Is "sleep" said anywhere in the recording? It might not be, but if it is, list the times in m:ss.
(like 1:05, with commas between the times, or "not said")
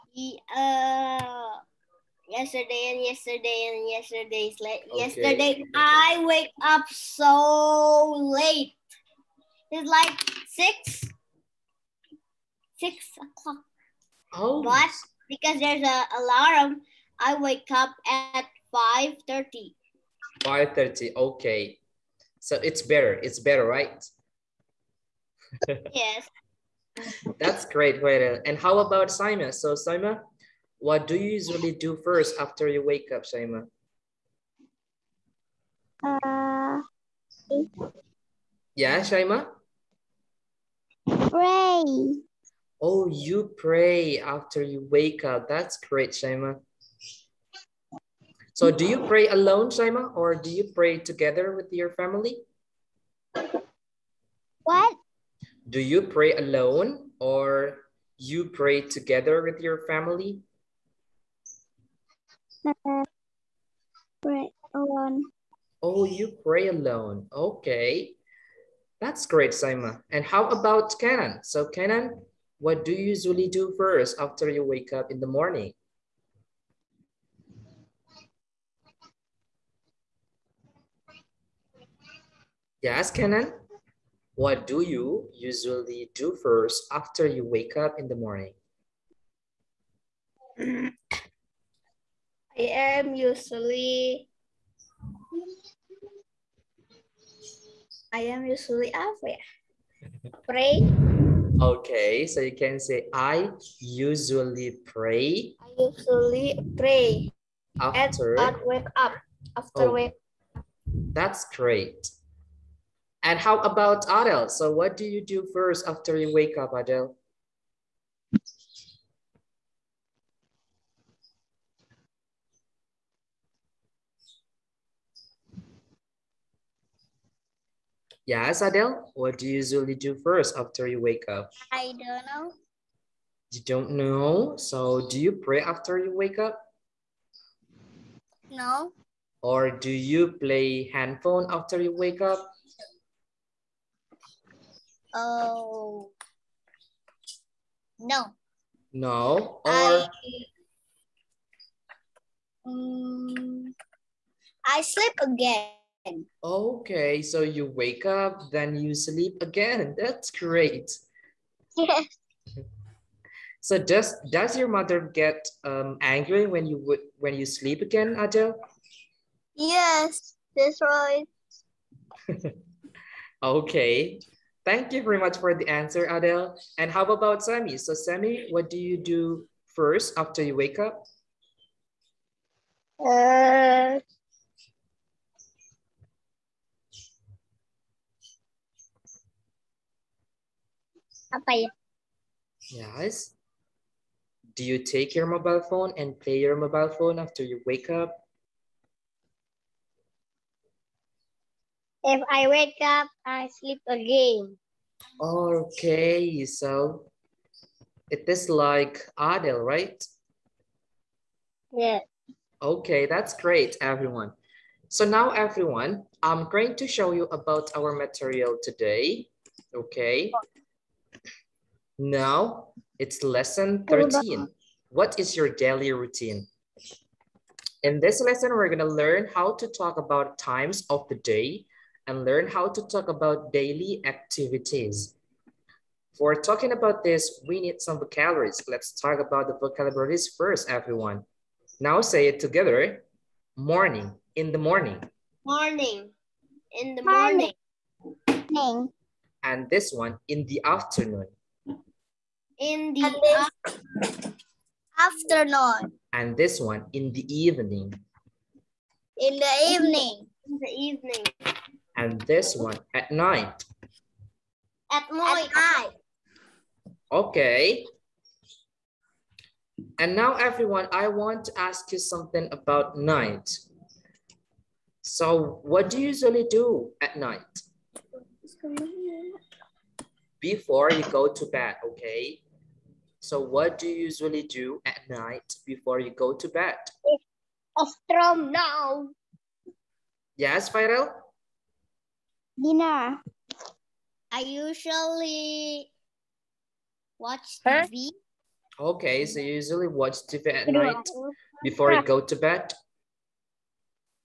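2:34, 2:38, 2:47, 3:23.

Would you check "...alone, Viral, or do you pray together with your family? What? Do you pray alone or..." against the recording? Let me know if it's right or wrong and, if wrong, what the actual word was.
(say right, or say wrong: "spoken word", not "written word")
wrong: "Shaima", not "Viral".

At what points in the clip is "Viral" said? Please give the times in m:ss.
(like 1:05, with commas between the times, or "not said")
4:50.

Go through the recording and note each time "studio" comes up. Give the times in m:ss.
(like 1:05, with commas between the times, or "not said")
not said.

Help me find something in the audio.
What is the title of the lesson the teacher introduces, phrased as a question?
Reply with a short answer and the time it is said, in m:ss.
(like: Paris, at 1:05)
What is your daily routine?, at 3:44.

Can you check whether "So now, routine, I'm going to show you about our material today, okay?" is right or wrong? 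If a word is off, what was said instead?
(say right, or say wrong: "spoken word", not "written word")
wrong: "everyone", not "routine".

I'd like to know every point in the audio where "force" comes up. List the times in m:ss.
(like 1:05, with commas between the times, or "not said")
not said.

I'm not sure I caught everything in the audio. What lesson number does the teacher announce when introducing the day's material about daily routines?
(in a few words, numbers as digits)
13.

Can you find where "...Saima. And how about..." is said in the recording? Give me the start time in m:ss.
1:09.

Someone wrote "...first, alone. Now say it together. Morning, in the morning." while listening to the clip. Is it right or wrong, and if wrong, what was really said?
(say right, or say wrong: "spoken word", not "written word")
wrong: "everyone", not "alone".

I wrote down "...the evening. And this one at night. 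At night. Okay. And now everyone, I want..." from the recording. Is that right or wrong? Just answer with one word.
right.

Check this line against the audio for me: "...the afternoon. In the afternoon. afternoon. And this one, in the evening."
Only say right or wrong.
right.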